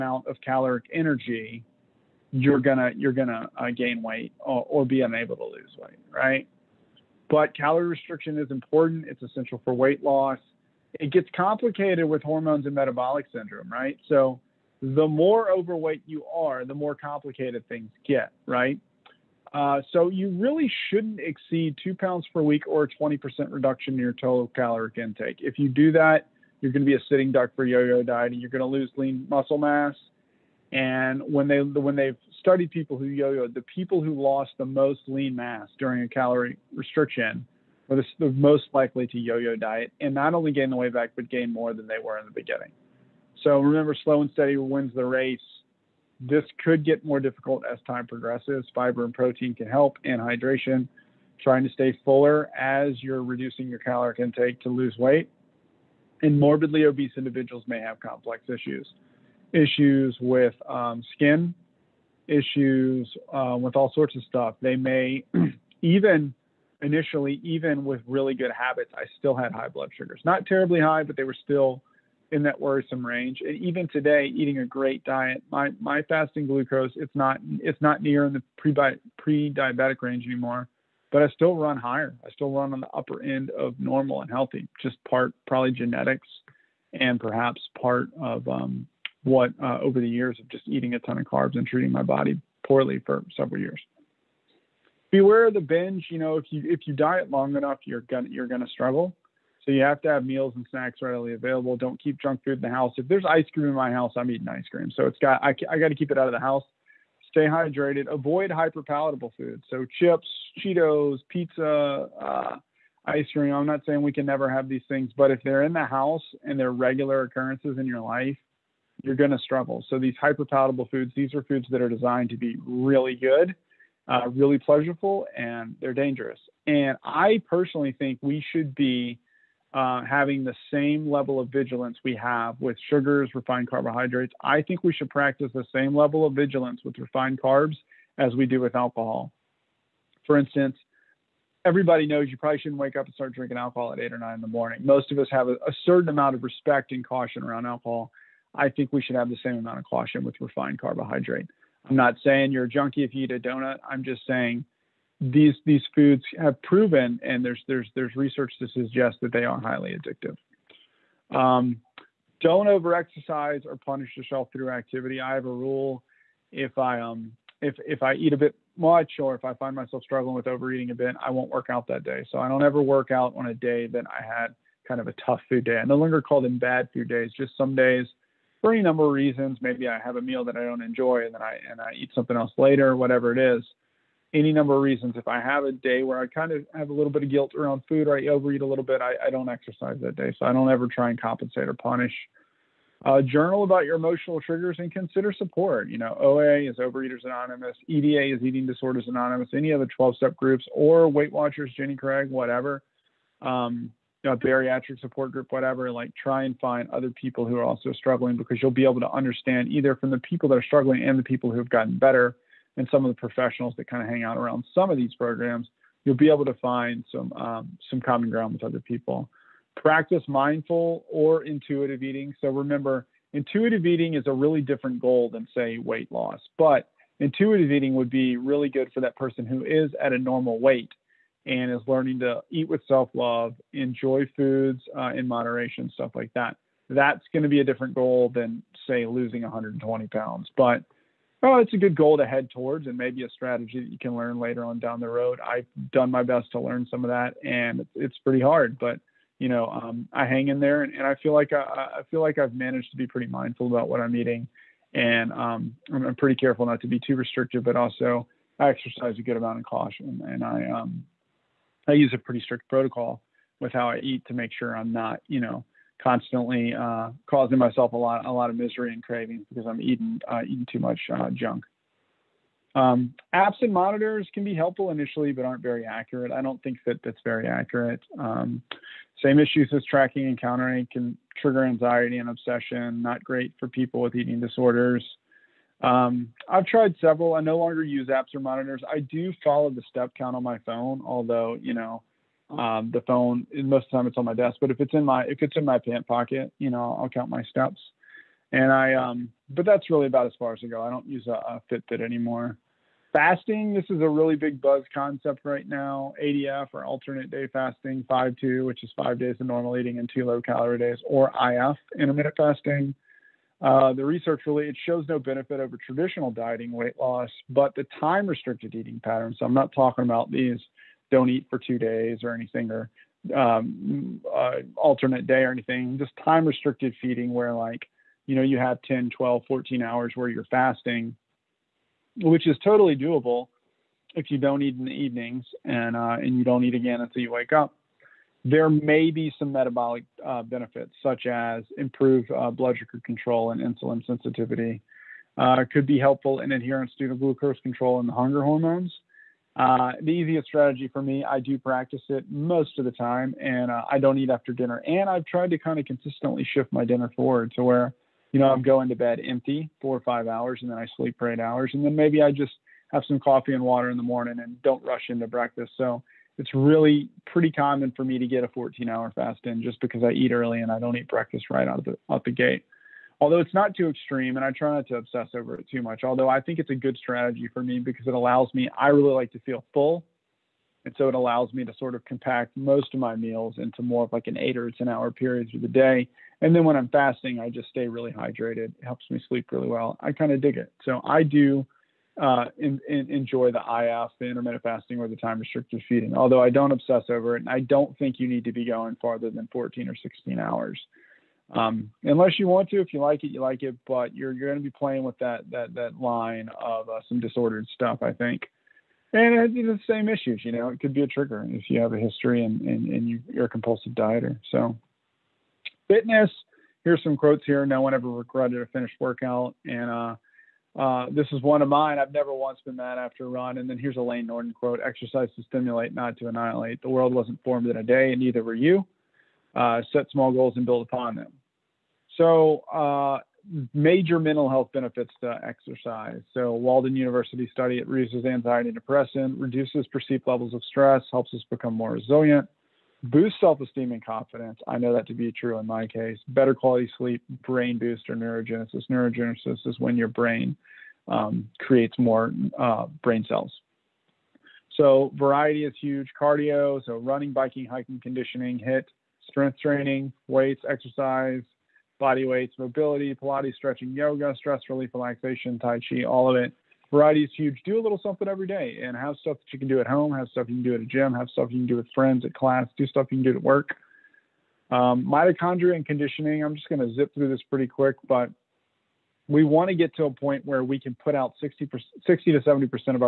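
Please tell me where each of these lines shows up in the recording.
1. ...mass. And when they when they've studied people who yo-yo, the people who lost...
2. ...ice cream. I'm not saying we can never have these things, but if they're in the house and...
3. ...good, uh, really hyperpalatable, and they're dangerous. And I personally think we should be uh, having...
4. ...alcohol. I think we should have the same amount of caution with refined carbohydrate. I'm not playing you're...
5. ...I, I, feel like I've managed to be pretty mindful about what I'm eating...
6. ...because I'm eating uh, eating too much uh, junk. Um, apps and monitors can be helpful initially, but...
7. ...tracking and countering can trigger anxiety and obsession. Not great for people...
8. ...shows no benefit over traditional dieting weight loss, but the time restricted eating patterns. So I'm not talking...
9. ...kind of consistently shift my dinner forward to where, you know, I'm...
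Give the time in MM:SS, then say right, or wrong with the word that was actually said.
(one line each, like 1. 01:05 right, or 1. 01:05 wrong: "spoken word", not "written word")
1. 00:29 right
2. 01:53 right
3. 02:03 wrong: "pleasurable", not "hyperpalatable"
4. 02:27 wrong: "saying", not "playing"
5. 04:11 right
6. 04:29 right
7. 04:39 right
8. 05:14 right
9. 05:55 right.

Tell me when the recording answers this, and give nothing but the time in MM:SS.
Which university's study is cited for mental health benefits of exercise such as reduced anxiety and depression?
07:16.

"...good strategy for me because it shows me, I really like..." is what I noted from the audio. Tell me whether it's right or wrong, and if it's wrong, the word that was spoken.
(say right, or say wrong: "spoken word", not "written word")
wrong: "allows", not "shows".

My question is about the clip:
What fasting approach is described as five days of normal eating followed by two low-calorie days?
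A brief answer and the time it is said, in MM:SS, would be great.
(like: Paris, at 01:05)
five two, at 05:08.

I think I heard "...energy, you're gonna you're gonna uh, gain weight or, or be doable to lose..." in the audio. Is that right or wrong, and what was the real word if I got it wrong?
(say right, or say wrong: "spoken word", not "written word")
wrong: "unable", not "doable".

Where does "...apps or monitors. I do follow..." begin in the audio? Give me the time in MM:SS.
04:48.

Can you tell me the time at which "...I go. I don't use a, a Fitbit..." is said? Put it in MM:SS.
05:00.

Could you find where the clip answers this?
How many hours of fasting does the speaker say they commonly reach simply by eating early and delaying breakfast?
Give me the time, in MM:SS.
06:08.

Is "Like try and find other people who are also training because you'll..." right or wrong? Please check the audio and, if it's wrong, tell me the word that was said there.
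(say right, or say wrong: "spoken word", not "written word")
wrong: "struggling", not "training".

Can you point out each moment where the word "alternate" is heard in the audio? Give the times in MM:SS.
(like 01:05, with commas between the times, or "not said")
05:06, 05:24.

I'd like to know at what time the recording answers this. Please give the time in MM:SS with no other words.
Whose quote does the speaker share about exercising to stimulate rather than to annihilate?
07:04.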